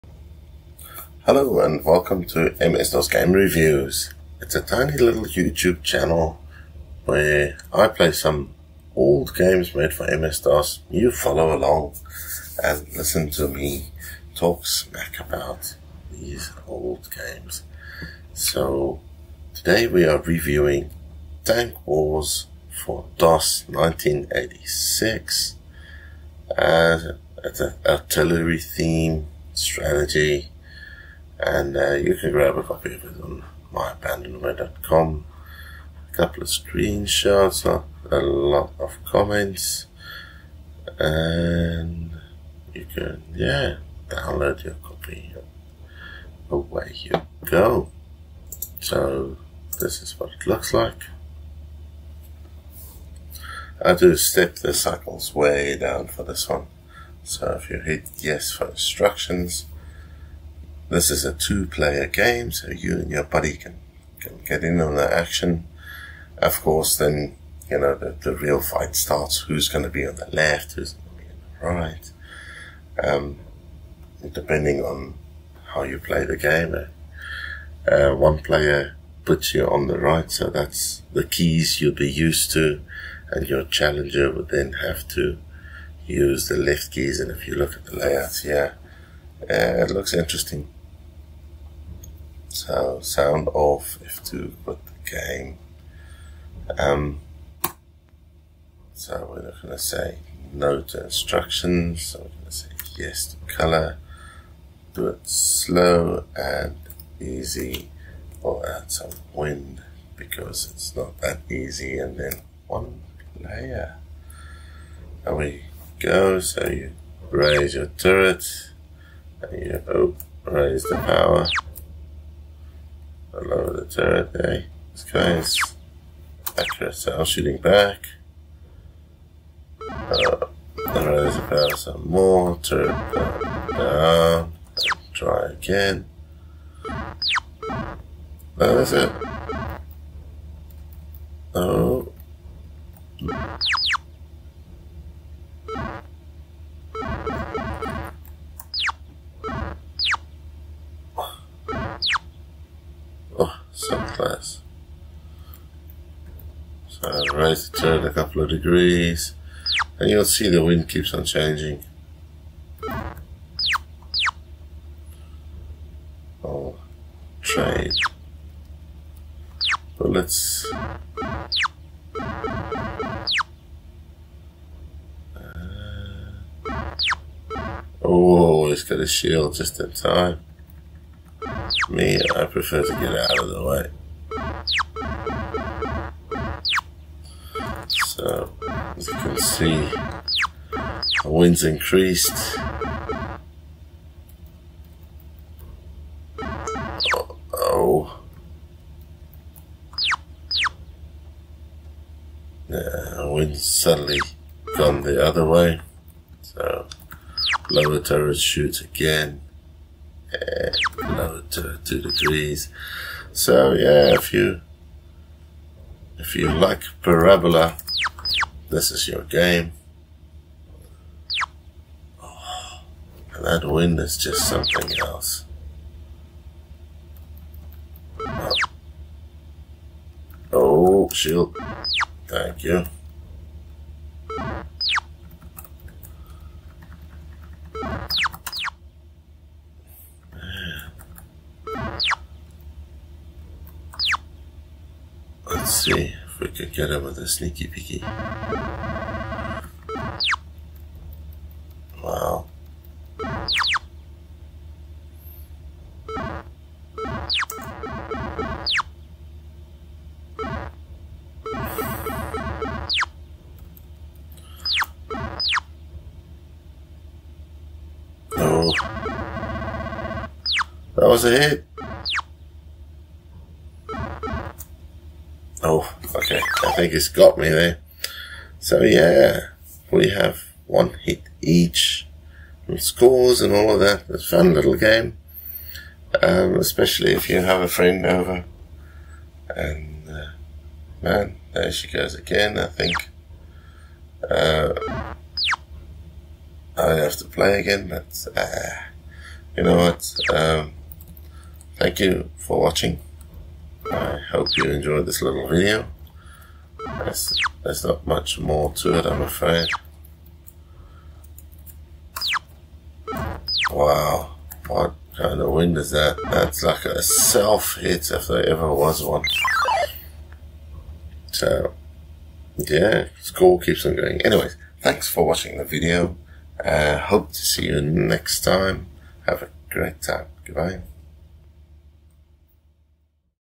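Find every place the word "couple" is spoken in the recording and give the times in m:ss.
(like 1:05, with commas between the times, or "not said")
0:36, 2:38.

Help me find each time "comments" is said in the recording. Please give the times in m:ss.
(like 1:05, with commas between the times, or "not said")
0:39.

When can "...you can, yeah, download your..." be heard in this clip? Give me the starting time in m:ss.
0:42.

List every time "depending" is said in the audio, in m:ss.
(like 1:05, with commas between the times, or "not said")
1:14.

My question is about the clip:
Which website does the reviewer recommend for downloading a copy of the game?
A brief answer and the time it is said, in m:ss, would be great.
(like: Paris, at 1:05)
myabandonware.com, at 0:33.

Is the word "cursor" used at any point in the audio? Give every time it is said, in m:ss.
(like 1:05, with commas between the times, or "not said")
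not said.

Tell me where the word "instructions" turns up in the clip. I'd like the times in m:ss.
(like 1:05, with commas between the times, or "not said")
0:58, 1:41.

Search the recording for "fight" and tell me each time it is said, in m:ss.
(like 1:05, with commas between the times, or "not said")
1:08.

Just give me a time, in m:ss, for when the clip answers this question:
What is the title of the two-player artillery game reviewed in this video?
0:21.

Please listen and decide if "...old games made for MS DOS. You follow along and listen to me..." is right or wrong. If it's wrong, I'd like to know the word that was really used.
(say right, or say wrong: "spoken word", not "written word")
right.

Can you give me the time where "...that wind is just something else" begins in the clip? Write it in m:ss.
3:43.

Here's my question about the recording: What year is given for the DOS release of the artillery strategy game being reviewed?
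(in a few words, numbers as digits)
1986.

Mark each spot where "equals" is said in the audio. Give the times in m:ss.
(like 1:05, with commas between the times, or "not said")
not said.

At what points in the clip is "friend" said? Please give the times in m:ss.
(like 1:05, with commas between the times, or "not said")
4:47.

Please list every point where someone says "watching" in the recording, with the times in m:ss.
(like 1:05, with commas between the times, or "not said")
5:02, 5:25.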